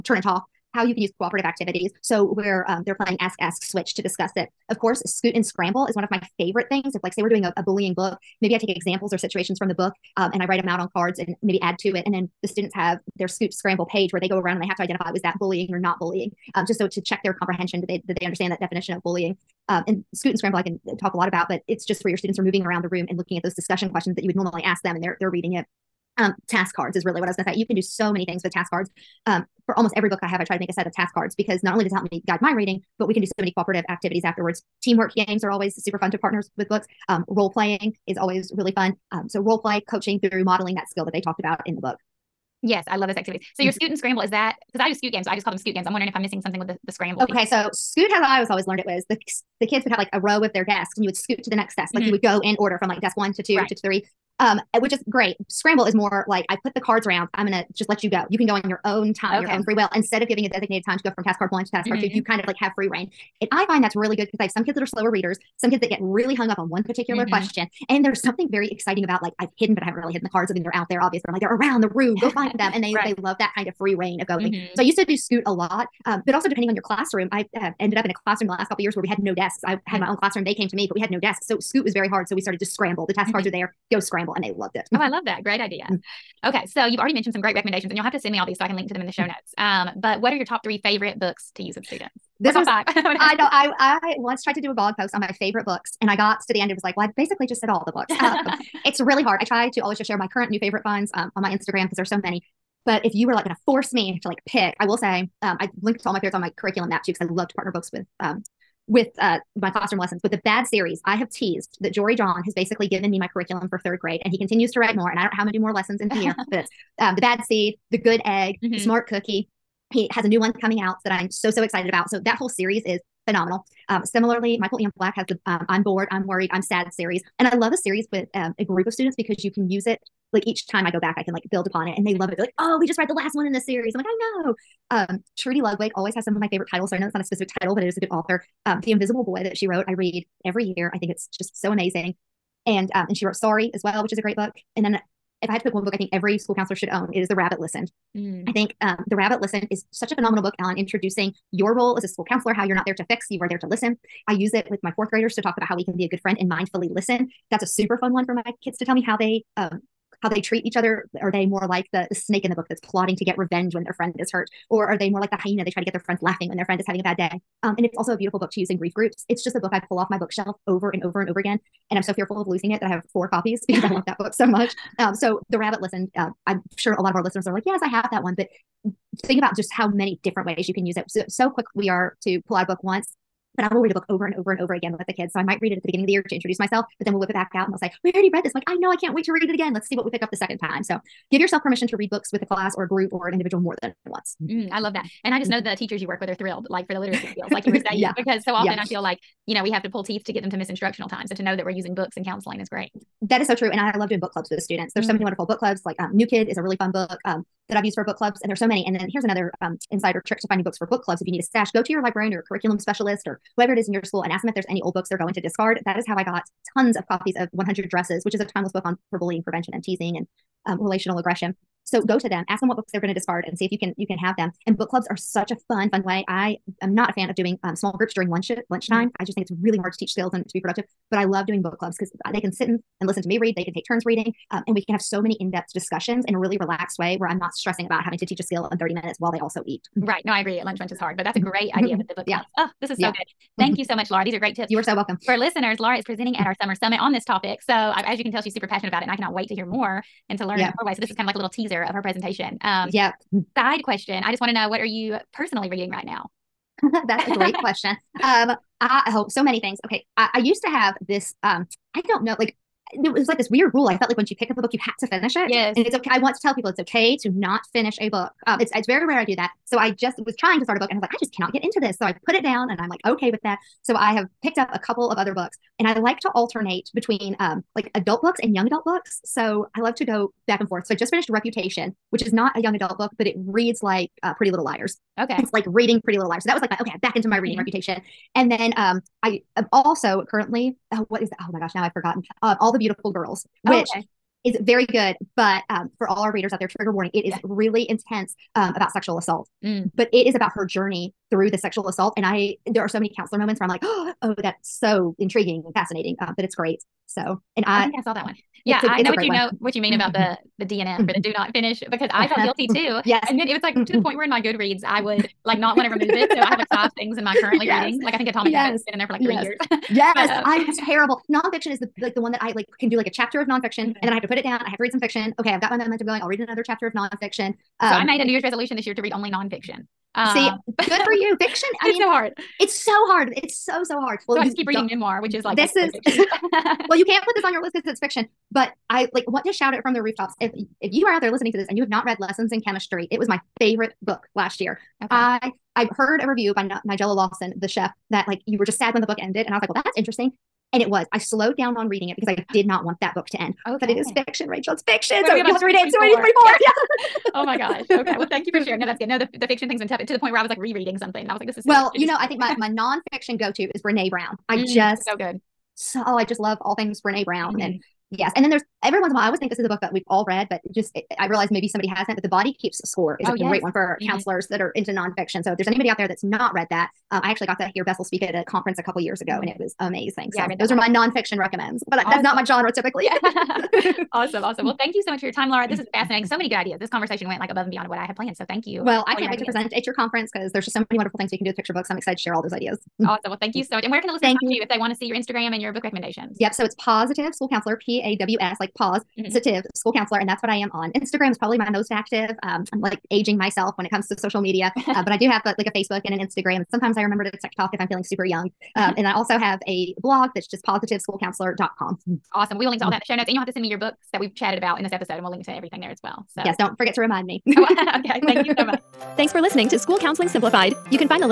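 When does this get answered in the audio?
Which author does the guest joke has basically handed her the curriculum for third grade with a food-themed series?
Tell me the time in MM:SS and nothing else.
01:51.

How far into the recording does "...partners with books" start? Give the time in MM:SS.
00:36.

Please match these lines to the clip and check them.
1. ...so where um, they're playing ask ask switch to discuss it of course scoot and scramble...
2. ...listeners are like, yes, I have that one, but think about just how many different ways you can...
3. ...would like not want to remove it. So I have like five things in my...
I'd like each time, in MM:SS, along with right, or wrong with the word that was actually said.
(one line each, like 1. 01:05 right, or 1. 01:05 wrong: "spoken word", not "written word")
1. 00:02 right
2. 02:57 right
3. 05:14 right.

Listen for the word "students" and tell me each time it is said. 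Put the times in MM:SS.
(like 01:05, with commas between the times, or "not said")
00:12, 00:22, 01:31, 02:08, 03:24.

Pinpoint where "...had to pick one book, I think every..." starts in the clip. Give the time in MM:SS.
02:25.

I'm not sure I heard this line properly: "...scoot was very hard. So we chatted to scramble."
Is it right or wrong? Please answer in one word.
wrong.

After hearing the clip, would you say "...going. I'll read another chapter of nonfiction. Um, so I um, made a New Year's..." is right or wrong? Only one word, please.
right.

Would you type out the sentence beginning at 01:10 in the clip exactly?
I mean, they're out there, obvious, but I'm like, they're around the room.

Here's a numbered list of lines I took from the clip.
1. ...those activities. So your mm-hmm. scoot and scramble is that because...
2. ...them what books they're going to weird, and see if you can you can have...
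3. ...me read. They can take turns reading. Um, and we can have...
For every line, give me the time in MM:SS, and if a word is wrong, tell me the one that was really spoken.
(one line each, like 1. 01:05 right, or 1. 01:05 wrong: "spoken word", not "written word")
1. 00:43 right
2. 03:42 wrong: "discard", not "weird"
3. 03:53 right.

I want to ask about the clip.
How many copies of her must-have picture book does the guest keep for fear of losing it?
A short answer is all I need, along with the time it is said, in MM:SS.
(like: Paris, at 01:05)
4, at 02:53.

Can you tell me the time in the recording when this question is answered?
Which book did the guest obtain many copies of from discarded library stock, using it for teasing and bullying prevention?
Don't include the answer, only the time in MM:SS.
03:37.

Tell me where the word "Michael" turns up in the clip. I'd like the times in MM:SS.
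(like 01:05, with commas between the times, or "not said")
02:04.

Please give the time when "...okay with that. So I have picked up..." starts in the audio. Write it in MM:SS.
04:33.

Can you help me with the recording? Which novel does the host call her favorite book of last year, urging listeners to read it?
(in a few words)
Lessons in Chemistry.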